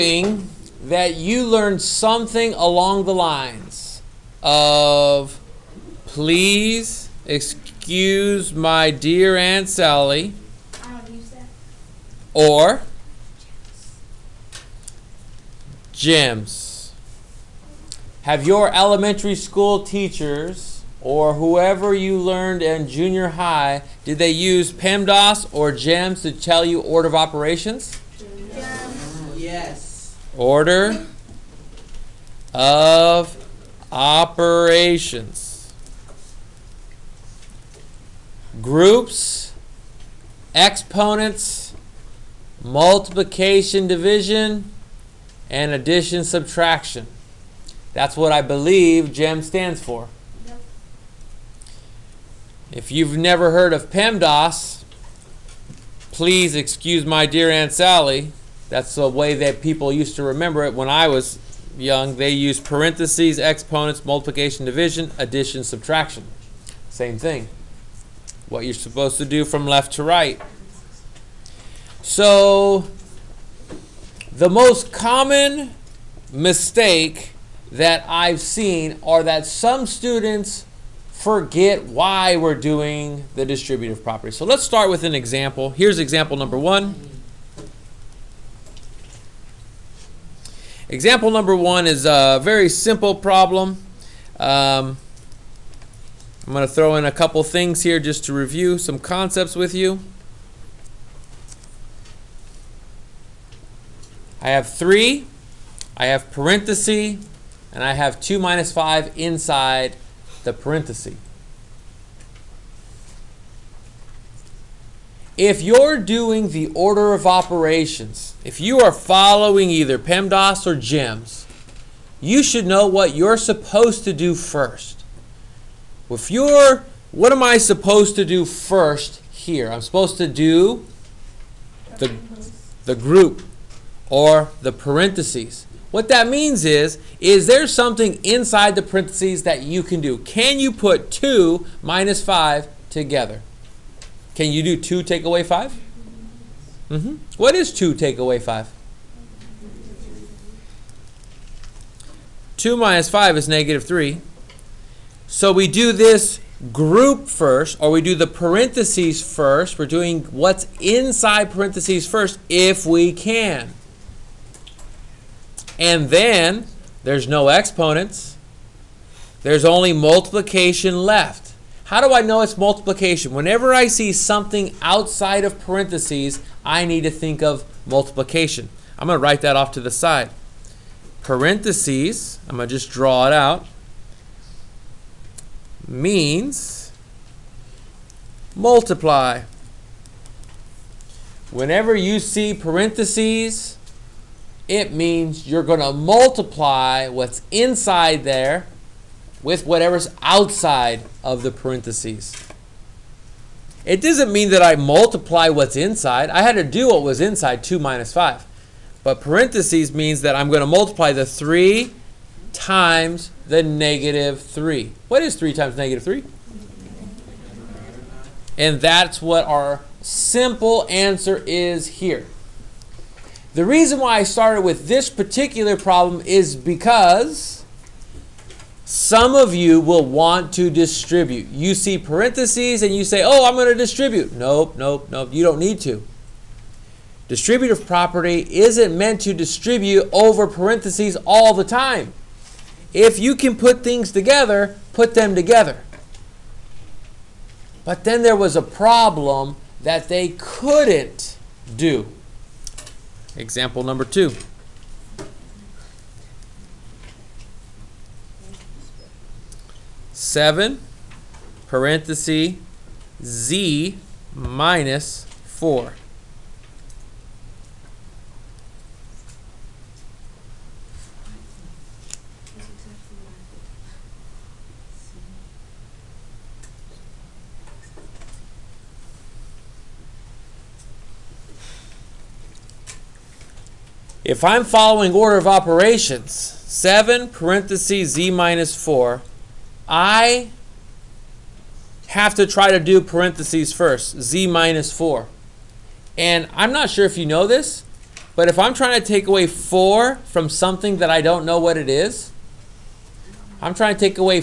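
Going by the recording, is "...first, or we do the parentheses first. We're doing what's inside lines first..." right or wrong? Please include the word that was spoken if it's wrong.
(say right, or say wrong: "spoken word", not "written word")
wrong: "parentheses", not "lines".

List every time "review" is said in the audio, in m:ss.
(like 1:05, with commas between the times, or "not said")
1:38.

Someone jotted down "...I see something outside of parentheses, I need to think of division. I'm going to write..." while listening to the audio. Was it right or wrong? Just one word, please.
wrong.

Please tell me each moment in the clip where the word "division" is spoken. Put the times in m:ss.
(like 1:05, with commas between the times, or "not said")
0:43, 1:04.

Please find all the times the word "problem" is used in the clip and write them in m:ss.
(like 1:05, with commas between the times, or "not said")
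1:33, 3:45, 4:08.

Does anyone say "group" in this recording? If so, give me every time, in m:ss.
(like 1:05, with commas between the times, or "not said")
0:38, 2:12, 2:36.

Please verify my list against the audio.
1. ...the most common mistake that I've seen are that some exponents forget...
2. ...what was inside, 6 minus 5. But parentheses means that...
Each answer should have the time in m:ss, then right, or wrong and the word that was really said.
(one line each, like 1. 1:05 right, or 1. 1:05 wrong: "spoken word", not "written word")
1. 1:14 wrong: "students", not "exponents"
2. 3:26 wrong: "2", not "6".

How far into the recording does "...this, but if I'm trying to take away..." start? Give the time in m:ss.
4:57.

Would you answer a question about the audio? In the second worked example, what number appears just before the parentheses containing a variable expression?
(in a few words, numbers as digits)
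7.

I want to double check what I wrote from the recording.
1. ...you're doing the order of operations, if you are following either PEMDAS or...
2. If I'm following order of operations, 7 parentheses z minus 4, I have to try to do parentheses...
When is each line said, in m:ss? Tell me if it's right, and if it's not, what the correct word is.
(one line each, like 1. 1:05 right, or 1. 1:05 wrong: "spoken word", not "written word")
1. 1:55 right
2. 4:44 right.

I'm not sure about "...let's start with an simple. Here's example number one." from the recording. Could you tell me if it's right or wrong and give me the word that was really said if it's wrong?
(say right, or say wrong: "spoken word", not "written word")
wrong: "example", not "simple".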